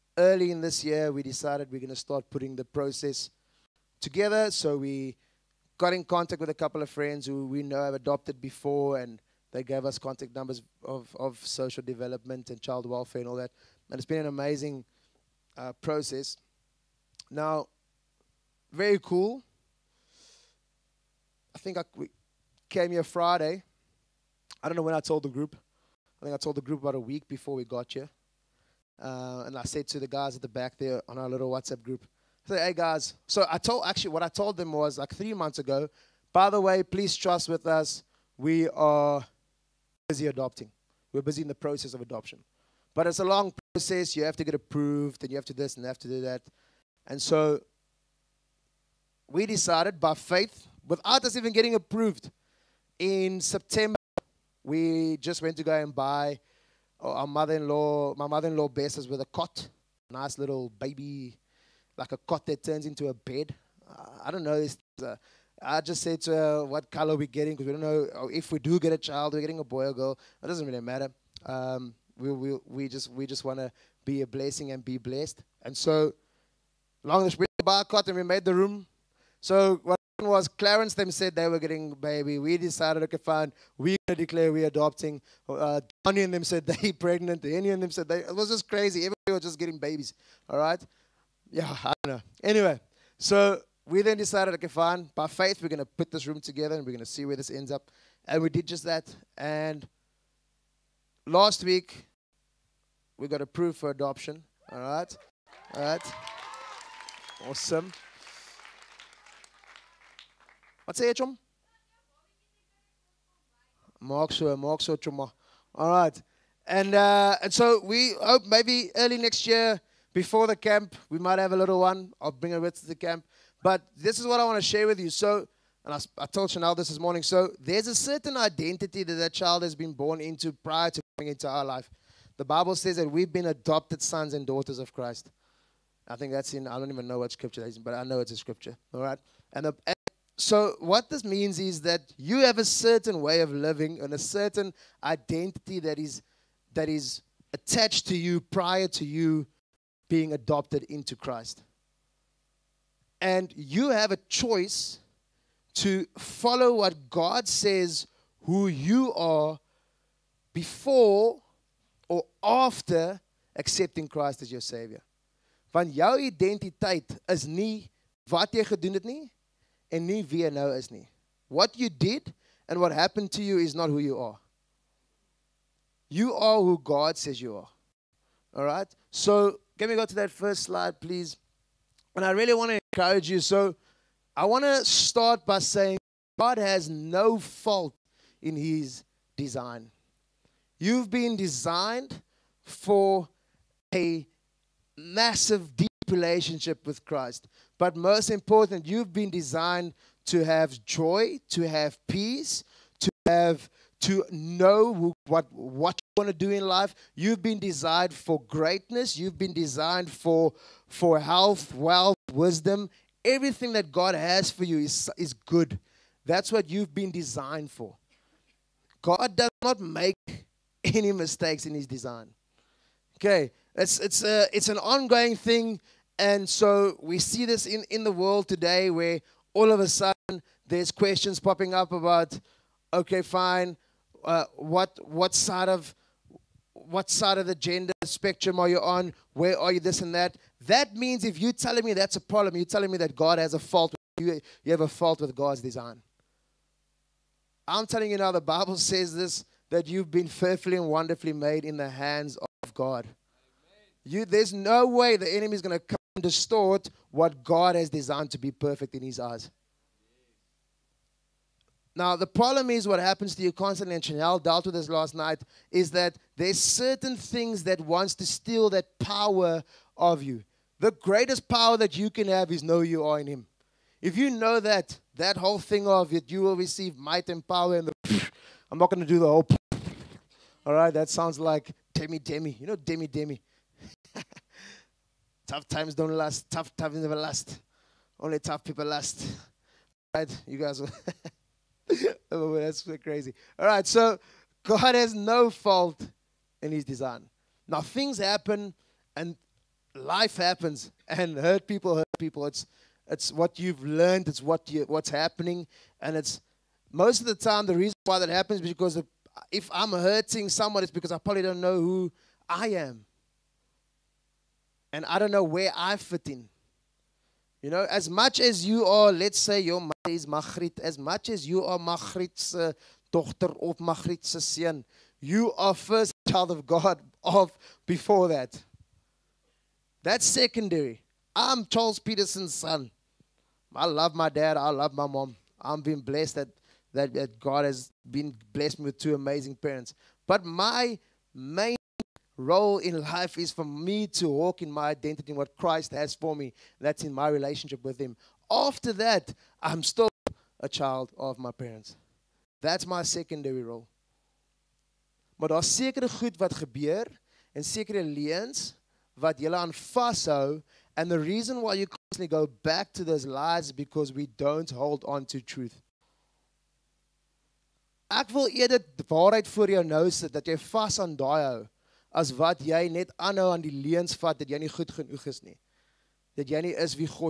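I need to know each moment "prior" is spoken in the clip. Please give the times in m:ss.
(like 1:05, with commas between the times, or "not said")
2:10, 2:28.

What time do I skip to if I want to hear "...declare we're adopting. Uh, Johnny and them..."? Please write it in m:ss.
1:24.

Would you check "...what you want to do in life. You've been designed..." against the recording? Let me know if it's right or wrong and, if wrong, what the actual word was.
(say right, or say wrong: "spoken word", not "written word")
right.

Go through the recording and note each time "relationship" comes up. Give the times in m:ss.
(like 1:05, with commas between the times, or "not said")
3:16, 5:47.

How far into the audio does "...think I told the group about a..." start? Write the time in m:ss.
0:26.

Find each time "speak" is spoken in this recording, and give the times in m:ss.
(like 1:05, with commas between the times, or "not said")
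not said.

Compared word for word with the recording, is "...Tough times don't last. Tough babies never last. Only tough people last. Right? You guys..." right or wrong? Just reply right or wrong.
wrong.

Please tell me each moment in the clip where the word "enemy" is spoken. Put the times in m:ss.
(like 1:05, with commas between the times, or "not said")
4:15.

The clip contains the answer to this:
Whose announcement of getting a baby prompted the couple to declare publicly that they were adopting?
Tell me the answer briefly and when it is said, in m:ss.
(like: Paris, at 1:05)
Clarence, at 1:20.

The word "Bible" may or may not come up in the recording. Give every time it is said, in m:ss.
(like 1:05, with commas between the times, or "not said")
2:12, 4:08.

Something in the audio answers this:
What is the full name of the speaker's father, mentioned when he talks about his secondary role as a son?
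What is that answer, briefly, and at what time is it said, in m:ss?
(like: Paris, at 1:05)
Charles Petersen, at 5:31.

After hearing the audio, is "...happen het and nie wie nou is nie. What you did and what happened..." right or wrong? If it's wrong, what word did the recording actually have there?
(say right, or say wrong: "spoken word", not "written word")
wrong: "gedoen", not "happen".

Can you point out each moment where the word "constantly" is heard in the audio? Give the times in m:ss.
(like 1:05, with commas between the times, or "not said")
4:23, 6:01.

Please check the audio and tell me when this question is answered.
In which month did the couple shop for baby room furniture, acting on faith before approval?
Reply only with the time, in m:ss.
0:53.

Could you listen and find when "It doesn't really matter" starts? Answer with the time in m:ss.
1:10.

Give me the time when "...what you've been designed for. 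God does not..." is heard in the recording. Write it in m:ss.
3:36.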